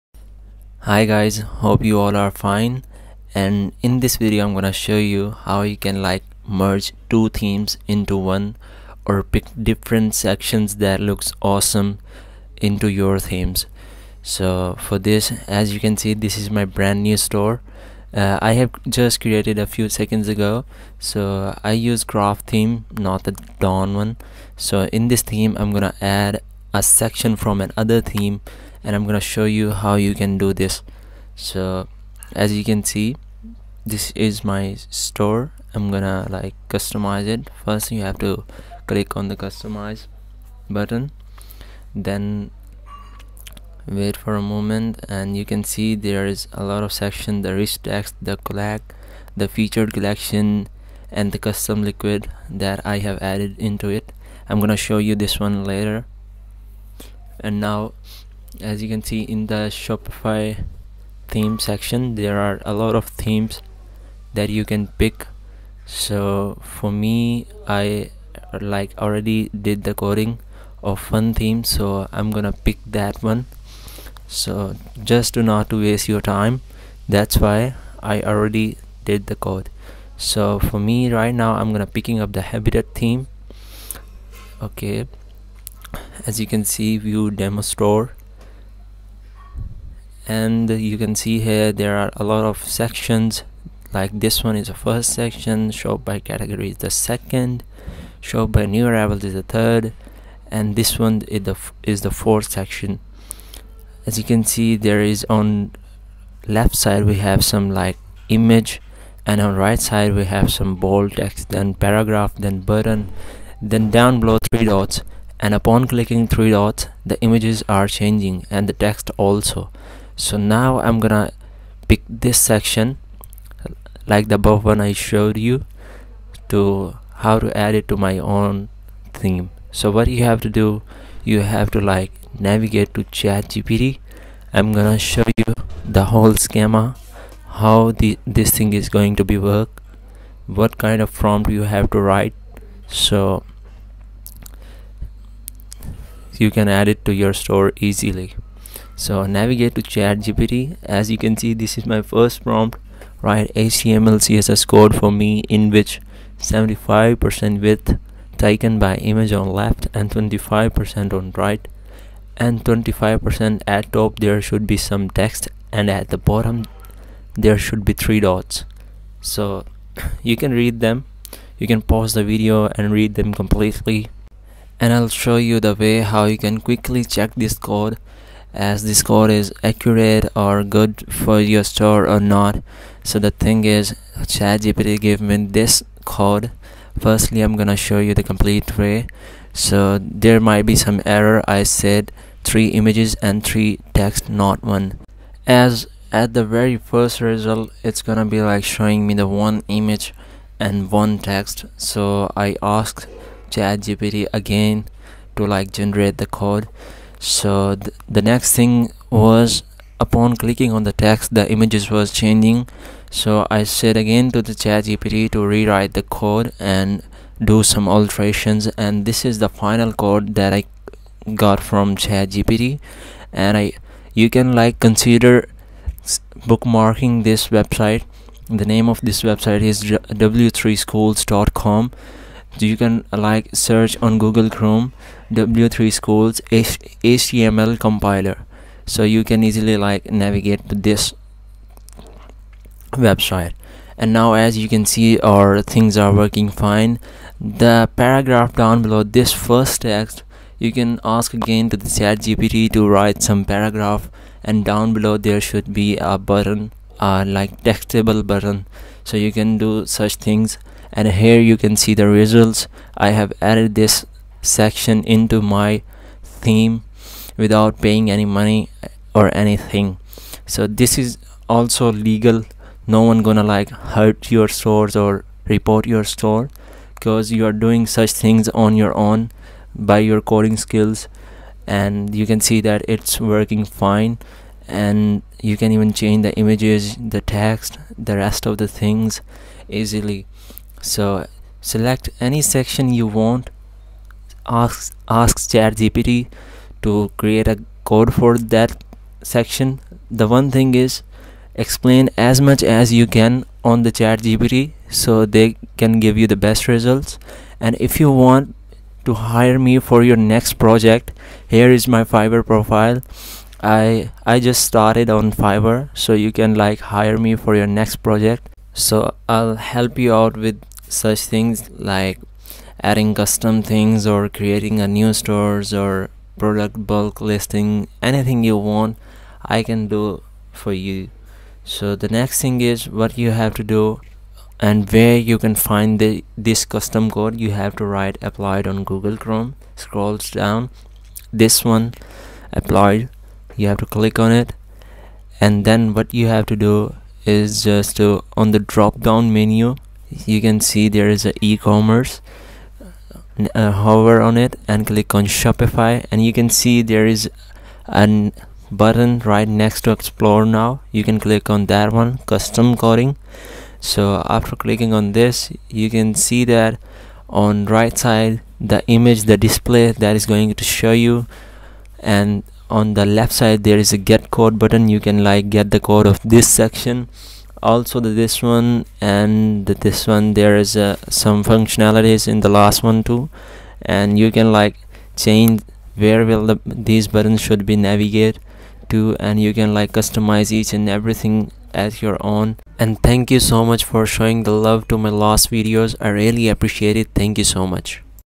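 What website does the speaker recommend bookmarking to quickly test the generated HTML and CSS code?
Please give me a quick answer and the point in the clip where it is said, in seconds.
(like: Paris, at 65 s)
w3schools.com, at 230 s.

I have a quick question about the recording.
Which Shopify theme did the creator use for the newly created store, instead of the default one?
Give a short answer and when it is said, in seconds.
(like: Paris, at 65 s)
Craft, at 22 s.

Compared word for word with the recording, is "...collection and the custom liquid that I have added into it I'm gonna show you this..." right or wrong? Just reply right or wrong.
right.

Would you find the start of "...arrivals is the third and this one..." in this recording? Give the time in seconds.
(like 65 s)
98 s.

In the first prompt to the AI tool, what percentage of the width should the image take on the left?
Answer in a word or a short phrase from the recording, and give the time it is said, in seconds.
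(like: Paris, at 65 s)
75%, at 156 s.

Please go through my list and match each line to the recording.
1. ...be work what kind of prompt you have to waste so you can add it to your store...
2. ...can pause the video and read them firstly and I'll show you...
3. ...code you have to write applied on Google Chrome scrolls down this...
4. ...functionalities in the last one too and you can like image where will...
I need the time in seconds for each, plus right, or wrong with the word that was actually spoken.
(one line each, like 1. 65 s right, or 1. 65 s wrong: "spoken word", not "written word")
1. 139 s wrong: "write", not "waste"
2. 171 s wrong: "completely", not "firstly"
3. 337 s right
4. 381 s wrong: "change", not "image".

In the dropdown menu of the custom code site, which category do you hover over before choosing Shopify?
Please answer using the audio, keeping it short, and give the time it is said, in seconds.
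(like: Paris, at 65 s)
E-commerce, at 351 s.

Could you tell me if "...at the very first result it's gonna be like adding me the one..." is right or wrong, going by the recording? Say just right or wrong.
wrong.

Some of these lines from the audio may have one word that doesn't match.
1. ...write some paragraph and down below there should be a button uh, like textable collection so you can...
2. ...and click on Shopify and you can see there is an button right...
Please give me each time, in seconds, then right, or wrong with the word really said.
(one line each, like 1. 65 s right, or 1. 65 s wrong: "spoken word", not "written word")
1. 252 s wrong: "button", not "collection"
2. 354 s right.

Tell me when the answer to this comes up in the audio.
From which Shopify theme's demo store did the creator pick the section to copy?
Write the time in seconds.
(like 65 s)
82 s.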